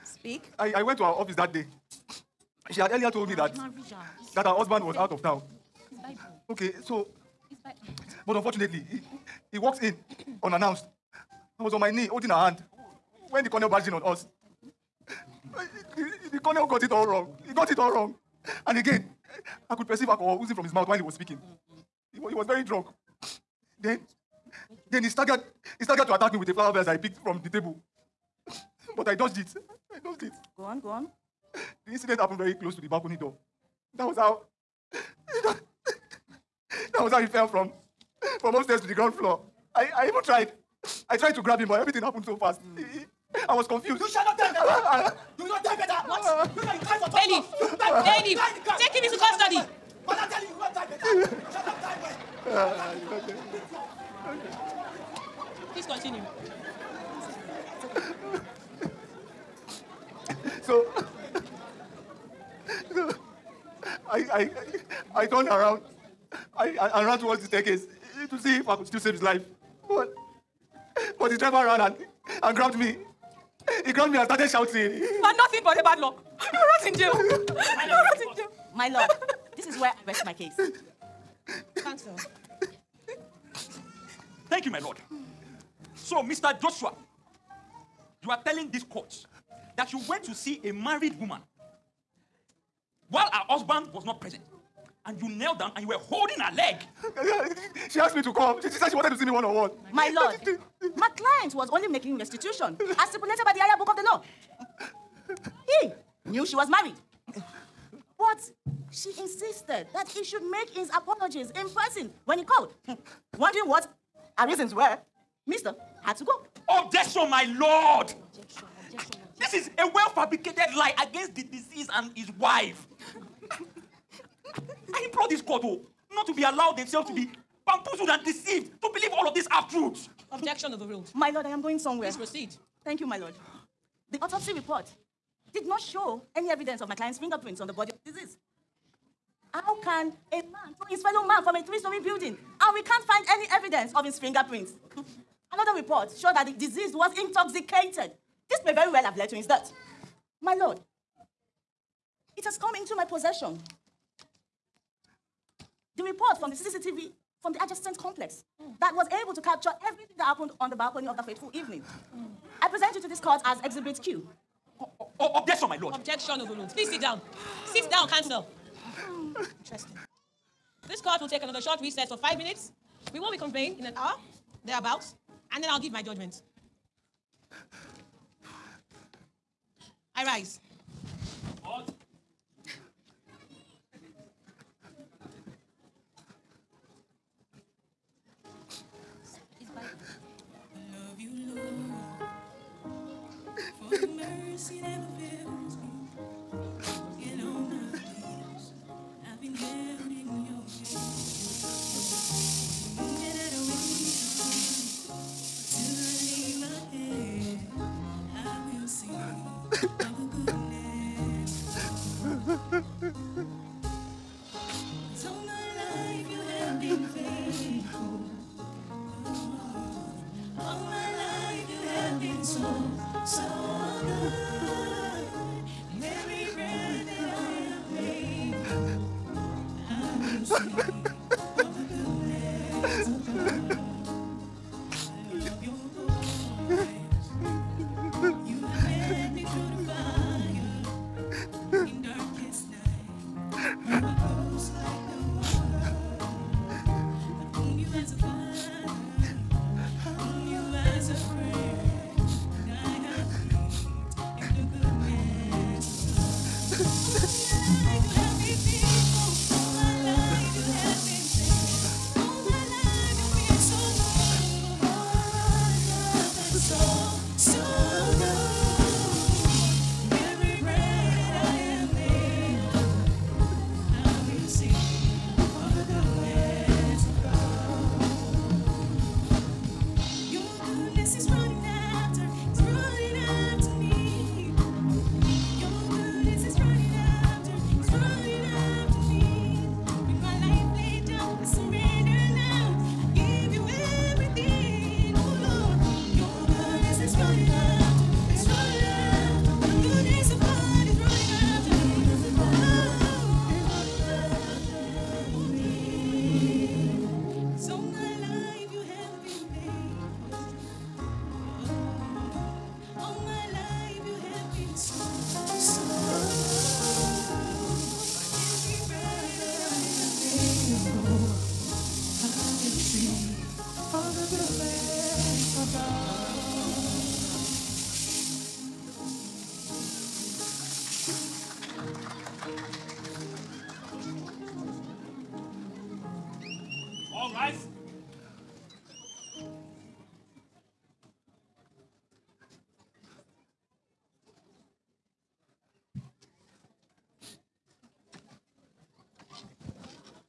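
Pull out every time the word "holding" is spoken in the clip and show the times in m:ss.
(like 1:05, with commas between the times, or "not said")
0:12, 1:35.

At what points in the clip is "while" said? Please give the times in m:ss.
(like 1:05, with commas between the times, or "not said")
0:20, 1:33.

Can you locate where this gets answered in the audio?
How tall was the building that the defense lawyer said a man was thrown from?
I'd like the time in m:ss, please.
2:21.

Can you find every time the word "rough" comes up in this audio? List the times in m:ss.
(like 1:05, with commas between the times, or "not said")
not said.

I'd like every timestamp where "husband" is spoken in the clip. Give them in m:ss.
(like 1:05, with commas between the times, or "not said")
0:04, 1:33.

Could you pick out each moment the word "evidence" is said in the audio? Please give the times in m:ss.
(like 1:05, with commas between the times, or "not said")
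2:16, 2:23.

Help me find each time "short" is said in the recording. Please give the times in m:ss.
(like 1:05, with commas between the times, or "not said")
2:51.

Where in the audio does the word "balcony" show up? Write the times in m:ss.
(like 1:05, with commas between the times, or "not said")
0:32, 2:40.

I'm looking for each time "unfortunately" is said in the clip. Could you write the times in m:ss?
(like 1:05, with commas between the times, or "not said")
0:08.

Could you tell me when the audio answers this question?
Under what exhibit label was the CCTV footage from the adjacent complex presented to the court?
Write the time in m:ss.
2:43.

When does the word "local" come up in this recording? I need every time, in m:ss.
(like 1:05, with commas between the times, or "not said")
not said.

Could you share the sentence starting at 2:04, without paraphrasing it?
I implore this court oh, not to be allowed themselves to be bamboozled and deceived to believe all of these half truths.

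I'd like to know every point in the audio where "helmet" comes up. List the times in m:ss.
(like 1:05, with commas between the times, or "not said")
not said.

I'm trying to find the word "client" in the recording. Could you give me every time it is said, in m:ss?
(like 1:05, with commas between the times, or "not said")
1:41, 2:16.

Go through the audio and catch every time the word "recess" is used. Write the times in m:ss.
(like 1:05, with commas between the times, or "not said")
2:51.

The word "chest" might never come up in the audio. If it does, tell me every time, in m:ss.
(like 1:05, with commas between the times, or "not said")
not said.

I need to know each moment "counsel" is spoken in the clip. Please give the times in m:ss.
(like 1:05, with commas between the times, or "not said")
1:21, 2:48.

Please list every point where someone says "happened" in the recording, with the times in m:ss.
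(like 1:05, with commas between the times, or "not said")
0:32, 0:42, 2:40.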